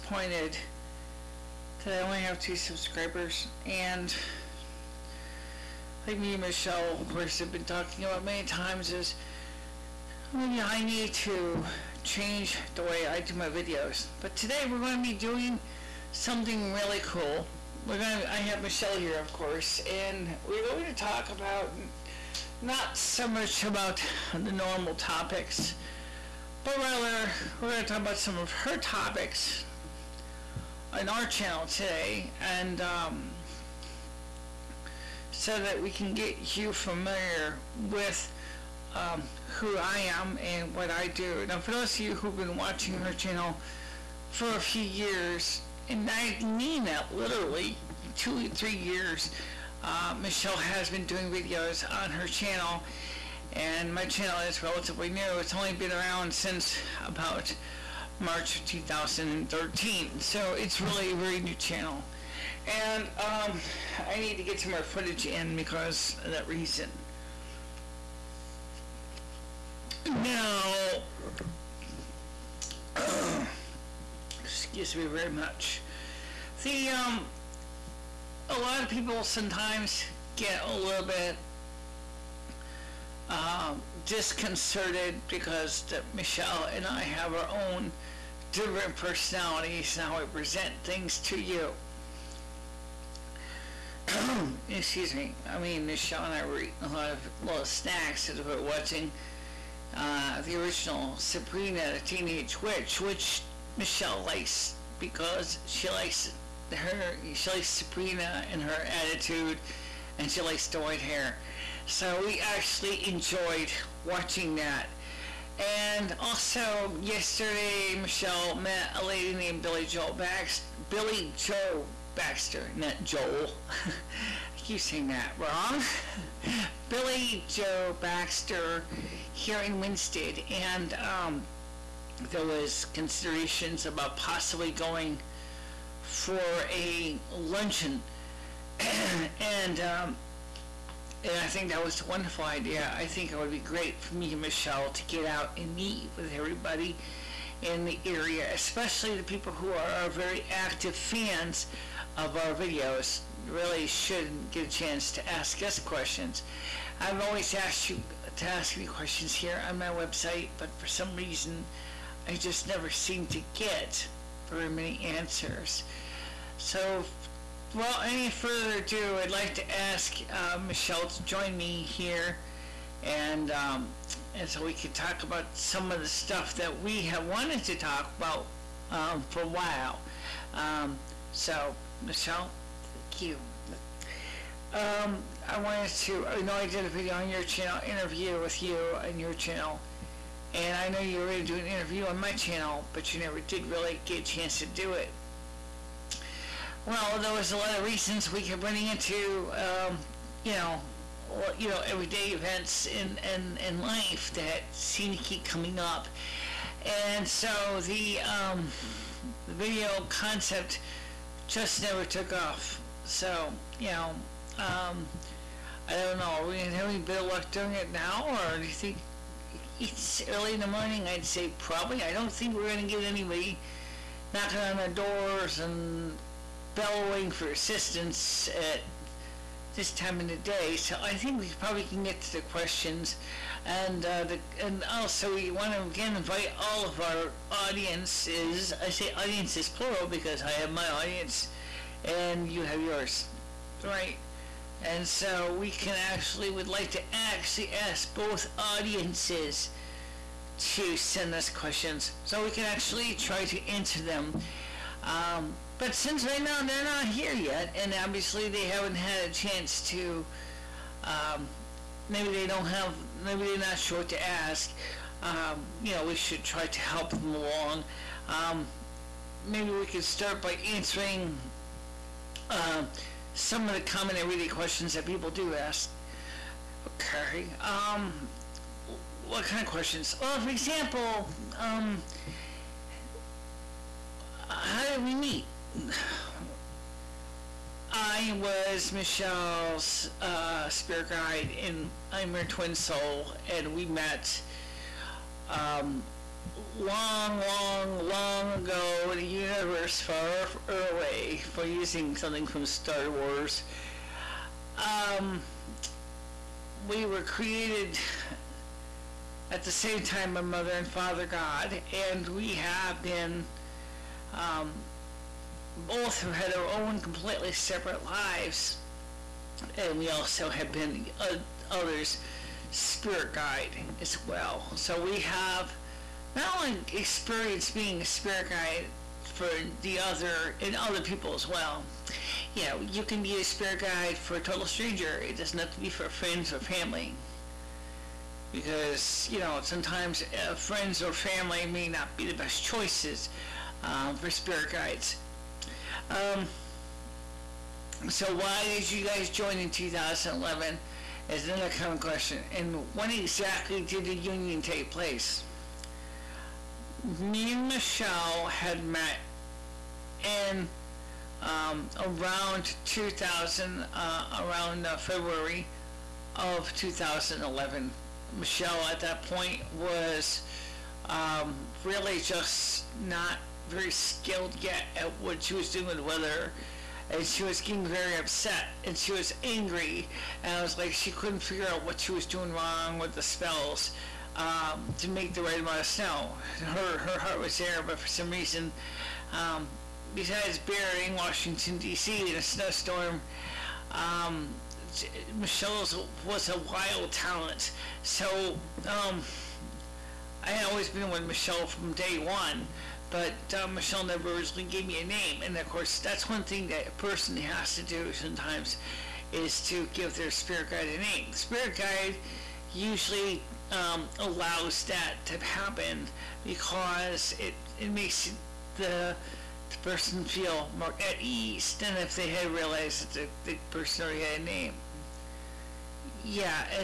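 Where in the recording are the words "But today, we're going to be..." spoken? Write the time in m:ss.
0:14.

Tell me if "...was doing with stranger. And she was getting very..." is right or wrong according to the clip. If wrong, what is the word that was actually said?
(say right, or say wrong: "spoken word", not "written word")
wrong: "weather", not "stranger".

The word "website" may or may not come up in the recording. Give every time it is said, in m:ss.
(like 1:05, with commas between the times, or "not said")
2:39.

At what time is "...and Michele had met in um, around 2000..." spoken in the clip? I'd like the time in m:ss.
5:57.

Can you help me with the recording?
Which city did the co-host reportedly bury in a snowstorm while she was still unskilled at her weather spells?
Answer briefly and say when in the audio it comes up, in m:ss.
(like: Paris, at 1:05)
Washington D.C., at 6:31.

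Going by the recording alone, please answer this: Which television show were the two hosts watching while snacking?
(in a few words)
Sabrina the Teenage Witch.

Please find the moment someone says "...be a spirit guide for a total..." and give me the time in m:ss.
5:33.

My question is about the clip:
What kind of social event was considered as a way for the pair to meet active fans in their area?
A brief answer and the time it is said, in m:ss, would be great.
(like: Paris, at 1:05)
a luncheon, at 2:16.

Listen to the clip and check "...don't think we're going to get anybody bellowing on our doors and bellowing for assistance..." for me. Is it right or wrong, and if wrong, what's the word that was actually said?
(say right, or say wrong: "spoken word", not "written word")
wrong: "knocking", not "bellowing".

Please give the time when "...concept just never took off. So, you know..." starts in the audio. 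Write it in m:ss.
3:30.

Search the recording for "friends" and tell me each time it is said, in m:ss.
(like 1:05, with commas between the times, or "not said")
5:36, 5:40.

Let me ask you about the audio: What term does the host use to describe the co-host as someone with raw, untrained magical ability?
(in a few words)
wild talent.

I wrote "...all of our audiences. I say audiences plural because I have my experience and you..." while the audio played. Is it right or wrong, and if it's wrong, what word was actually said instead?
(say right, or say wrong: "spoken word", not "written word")
wrong: "audience", not "experience".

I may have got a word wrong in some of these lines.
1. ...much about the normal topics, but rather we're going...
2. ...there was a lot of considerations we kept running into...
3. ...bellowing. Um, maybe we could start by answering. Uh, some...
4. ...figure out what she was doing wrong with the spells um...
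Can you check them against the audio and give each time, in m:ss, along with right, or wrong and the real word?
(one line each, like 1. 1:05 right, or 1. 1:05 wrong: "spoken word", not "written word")
1. 0:23 right
2. 3:17 wrong: "reasons", not "considerations"
3. 4:27 wrong: "along", not "bellowing"
4. 6:21 right.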